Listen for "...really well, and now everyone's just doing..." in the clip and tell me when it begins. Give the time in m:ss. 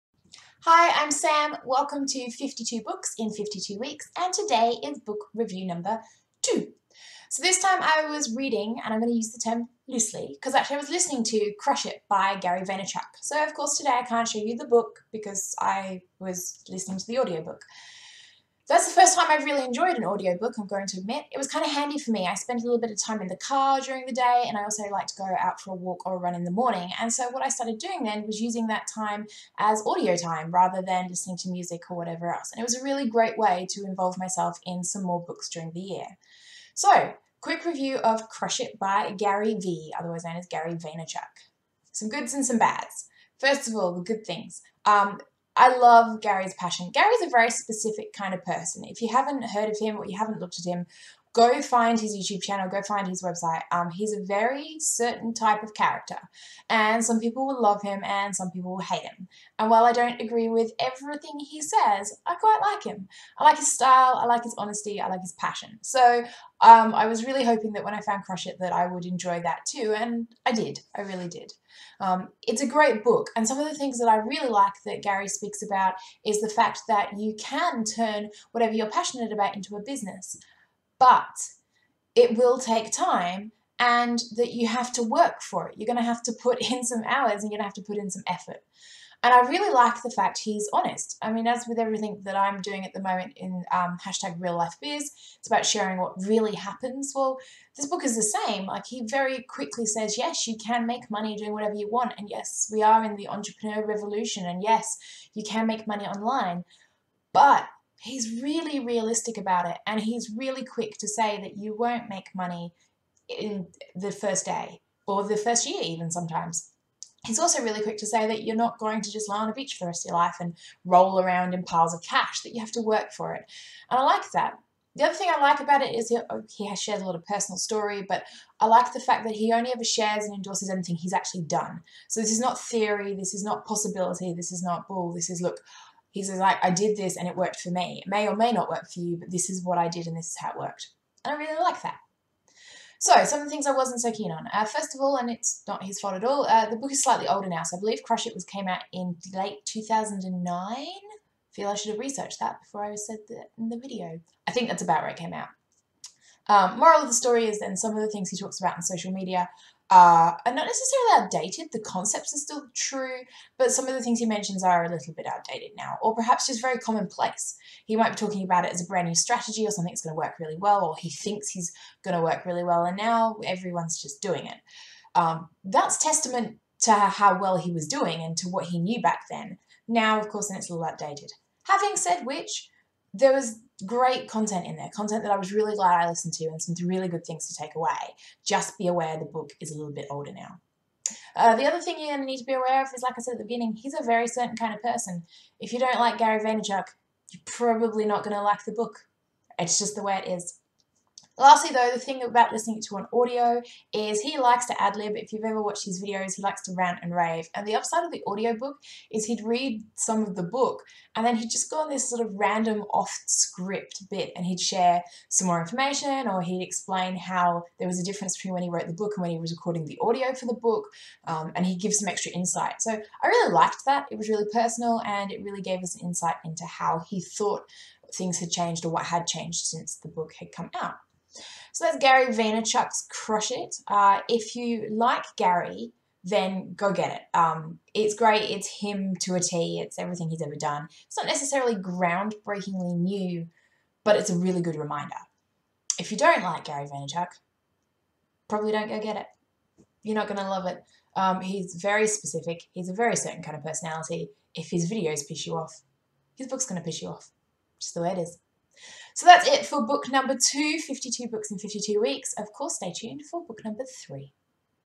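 2:52.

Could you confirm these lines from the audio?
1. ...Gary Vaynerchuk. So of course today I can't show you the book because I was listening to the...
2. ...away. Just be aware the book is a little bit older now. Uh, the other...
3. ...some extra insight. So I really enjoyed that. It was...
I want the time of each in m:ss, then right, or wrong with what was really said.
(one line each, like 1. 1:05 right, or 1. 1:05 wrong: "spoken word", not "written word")
1. 0:12 right
2. 3:07 right
3. 3:41 wrong: "liked", not "enjoyed".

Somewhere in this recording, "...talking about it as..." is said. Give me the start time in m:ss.
2:48.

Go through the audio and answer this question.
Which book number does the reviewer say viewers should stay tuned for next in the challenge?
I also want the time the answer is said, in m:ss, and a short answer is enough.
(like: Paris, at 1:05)
3, at 4:23.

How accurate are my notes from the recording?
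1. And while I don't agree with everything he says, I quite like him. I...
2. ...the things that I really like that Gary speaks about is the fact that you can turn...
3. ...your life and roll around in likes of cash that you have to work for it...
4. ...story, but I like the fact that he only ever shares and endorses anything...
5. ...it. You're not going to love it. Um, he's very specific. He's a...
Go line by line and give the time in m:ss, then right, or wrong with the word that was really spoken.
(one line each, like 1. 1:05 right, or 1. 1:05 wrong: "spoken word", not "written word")
1. 0:59 right
2. 1:13 right
3. 2:00 wrong: "piles", not "likes"
4. 2:07 right
5. 4:09 right.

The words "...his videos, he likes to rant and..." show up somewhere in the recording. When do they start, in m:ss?
3:25.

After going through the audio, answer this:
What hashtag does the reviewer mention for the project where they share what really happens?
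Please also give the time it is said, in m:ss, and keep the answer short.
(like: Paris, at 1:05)
real life biz, at 1:34.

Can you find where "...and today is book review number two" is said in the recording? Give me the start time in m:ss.
0:04.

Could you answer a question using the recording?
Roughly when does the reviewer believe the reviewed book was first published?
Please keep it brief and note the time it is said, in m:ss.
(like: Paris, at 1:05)
late 2009, at 2:29.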